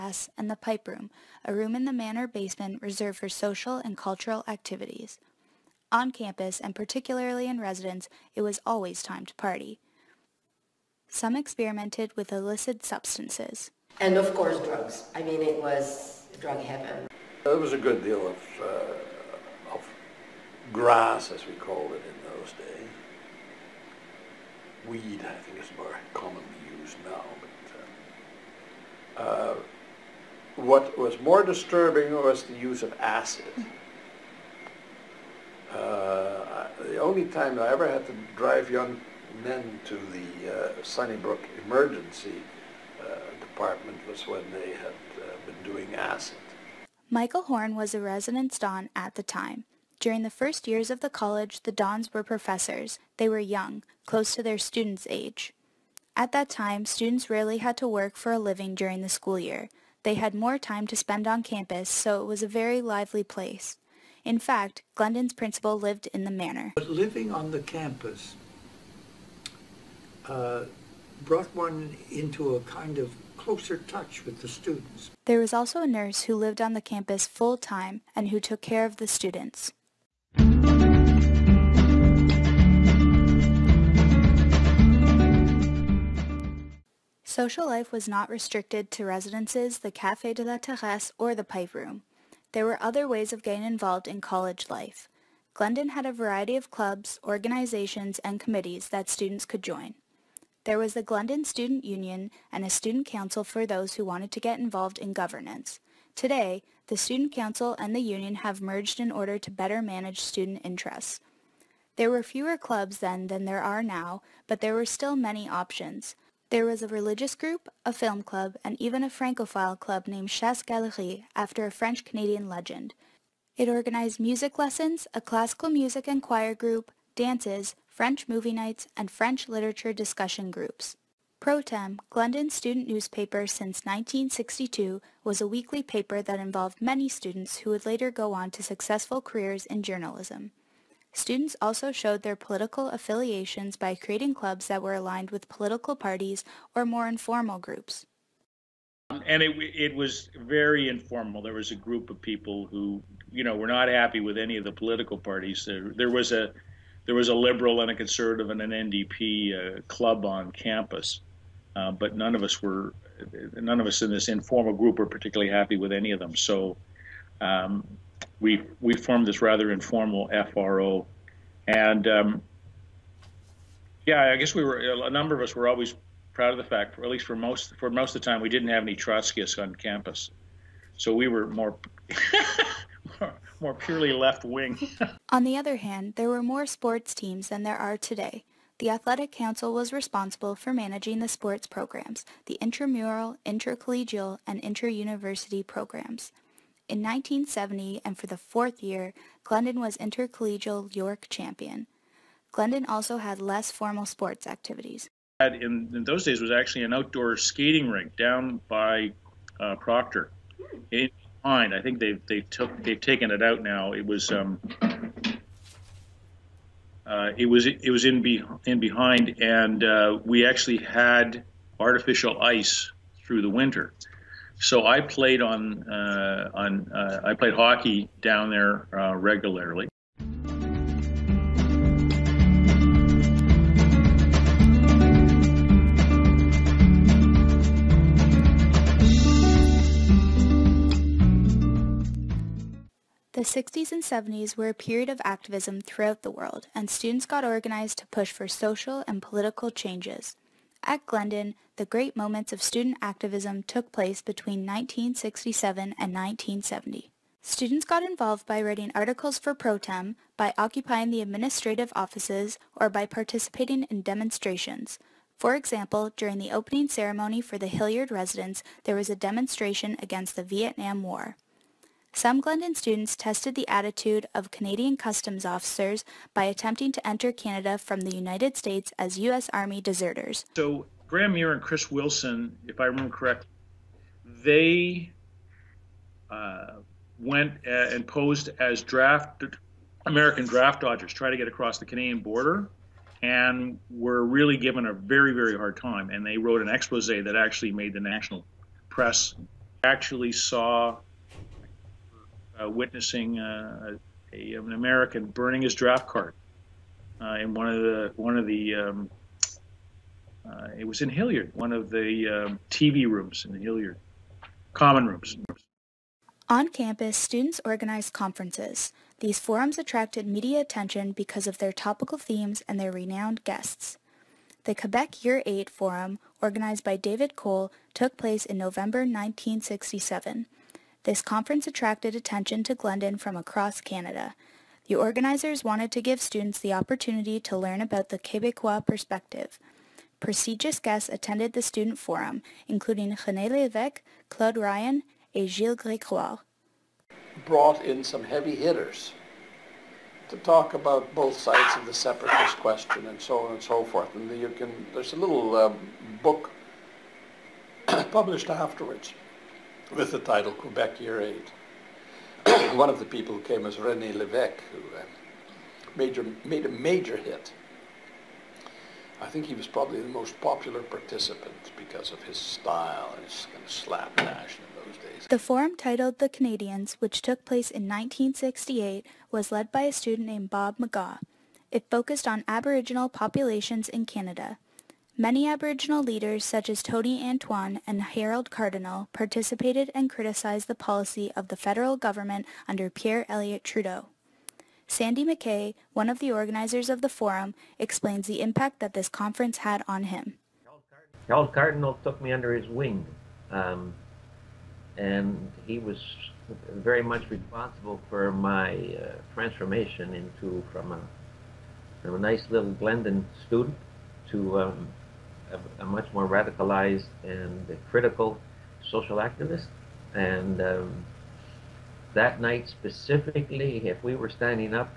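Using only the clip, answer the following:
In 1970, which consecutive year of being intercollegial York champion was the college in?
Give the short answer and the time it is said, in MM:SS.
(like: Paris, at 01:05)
fourth, at 03:18.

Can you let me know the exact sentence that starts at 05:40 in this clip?
Prestigious guests attended the student forum, including René Lévesque, Claude Ryan, and Gilles Grégoire.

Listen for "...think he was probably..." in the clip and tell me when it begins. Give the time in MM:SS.
06:09.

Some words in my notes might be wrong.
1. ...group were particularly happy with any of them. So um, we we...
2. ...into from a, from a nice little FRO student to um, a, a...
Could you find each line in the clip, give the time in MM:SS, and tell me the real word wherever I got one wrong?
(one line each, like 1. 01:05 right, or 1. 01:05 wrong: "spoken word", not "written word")
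1. 02:44 right
2. 06:50 wrong: "Glendon", not "FRO".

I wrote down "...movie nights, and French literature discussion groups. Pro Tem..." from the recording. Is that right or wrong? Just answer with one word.
right.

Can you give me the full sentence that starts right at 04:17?
Students got involved by writing articles for pro tem, by occupying the administrative offices, or by participating in demonstrations.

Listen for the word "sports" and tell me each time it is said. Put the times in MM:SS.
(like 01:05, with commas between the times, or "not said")
03:06, 03:11, 03:24.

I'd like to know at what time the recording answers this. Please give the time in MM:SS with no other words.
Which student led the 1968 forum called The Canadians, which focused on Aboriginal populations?
06:20.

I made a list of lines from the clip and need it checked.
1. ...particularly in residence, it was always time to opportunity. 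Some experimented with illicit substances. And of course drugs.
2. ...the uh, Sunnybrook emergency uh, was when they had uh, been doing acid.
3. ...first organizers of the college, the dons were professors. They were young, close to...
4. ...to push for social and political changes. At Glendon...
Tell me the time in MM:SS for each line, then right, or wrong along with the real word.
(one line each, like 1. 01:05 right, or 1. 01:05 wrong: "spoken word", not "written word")
1. 00:06 wrong: "party", not "opportunity"
2. 00:40 right
3. 00:50 wrong: "years", not "organizers"
4. 04:07 right.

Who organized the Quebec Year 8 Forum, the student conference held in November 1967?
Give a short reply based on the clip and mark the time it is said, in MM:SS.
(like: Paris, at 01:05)
David Cole, at 05:26.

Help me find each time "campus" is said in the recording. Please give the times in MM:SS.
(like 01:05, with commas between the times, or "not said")
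00:06, 01:01, 01:07, 01:16, 02:40, 02:59, 05:16.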